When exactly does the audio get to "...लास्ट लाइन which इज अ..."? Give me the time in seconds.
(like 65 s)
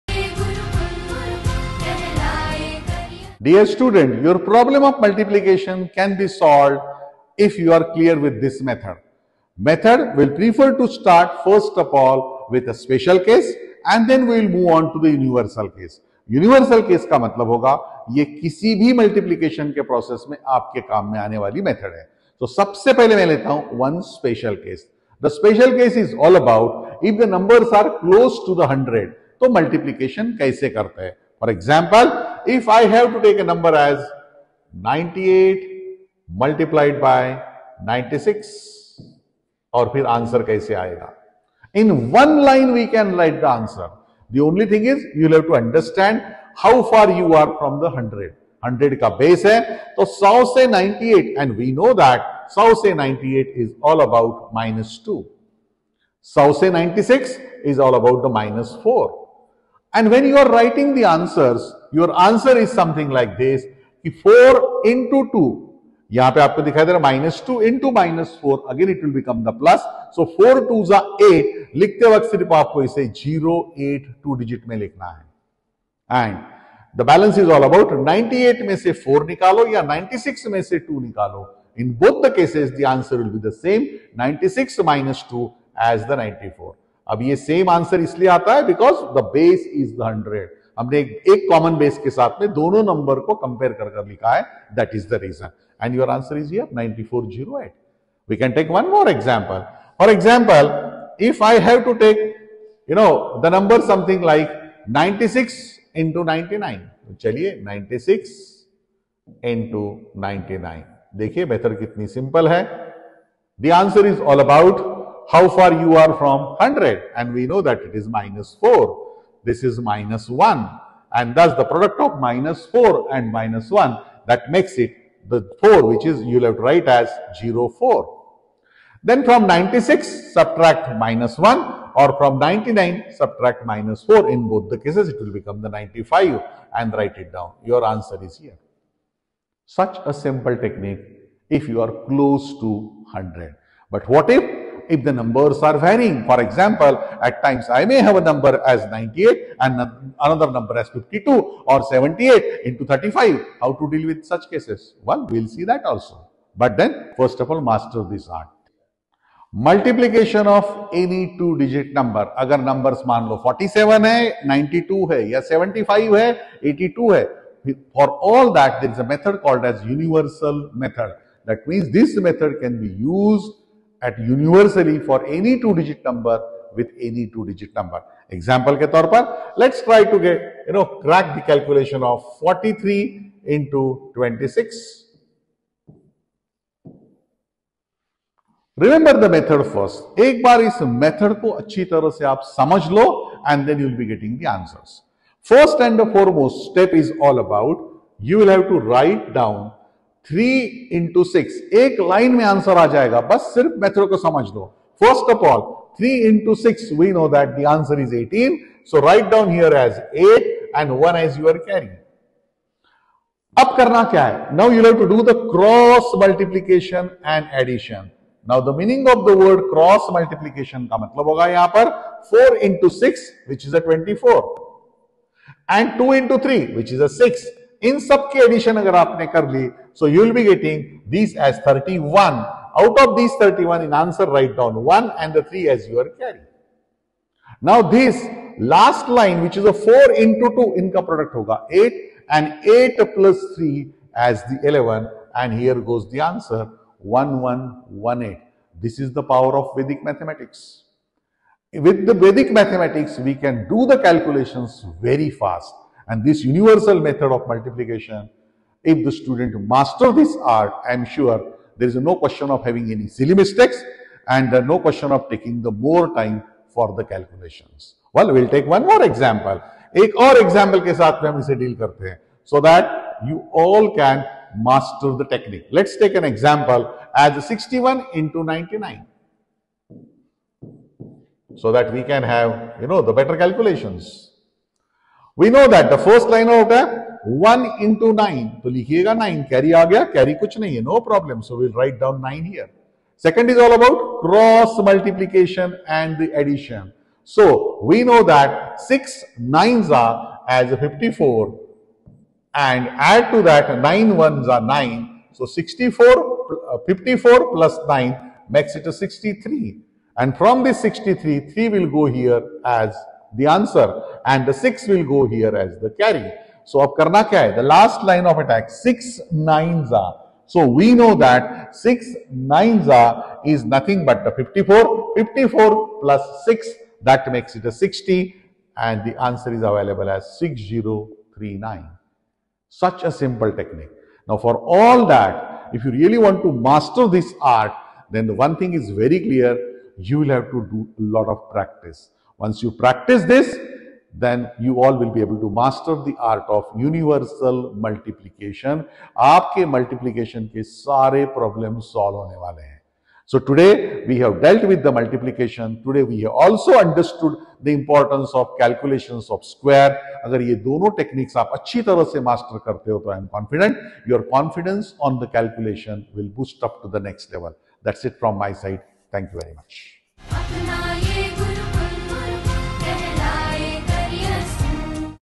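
238 s.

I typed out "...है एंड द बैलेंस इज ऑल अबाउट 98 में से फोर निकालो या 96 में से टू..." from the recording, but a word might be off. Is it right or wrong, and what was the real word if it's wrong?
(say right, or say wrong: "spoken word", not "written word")
right.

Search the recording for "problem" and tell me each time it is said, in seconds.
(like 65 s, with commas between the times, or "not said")
4 s, 351 s.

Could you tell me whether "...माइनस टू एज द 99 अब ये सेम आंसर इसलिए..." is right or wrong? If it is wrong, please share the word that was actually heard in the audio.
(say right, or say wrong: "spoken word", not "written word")
wrong: "94", not "99".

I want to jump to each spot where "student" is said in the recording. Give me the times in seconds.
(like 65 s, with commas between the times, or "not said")
3 s, 259 s.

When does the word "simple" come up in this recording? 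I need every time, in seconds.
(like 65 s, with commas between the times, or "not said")
140 s, 333 s.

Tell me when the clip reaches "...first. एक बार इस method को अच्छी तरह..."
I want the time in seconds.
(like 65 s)
189 s.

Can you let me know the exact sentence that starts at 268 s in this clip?
Well, we'll take one more example.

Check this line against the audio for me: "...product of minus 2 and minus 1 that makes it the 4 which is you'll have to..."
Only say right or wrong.
wrong.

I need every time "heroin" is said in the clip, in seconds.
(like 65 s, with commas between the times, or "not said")
not said.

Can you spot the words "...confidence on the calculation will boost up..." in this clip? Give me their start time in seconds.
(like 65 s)
364 s.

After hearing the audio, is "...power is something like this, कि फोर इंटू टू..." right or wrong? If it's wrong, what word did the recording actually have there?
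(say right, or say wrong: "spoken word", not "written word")
wrong: "answer", not "power".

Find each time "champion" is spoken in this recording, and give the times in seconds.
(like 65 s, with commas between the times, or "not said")
not said.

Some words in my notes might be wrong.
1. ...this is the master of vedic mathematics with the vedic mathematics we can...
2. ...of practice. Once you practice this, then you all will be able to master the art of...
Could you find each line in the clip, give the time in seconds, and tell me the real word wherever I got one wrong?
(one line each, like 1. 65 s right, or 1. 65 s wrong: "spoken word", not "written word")
1. 248 s wrong: "power", not "master"
2. 341 s right.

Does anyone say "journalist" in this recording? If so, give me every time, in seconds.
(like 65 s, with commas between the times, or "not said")
not said.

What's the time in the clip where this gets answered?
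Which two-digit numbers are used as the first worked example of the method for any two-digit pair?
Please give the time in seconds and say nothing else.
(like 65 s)
182 s.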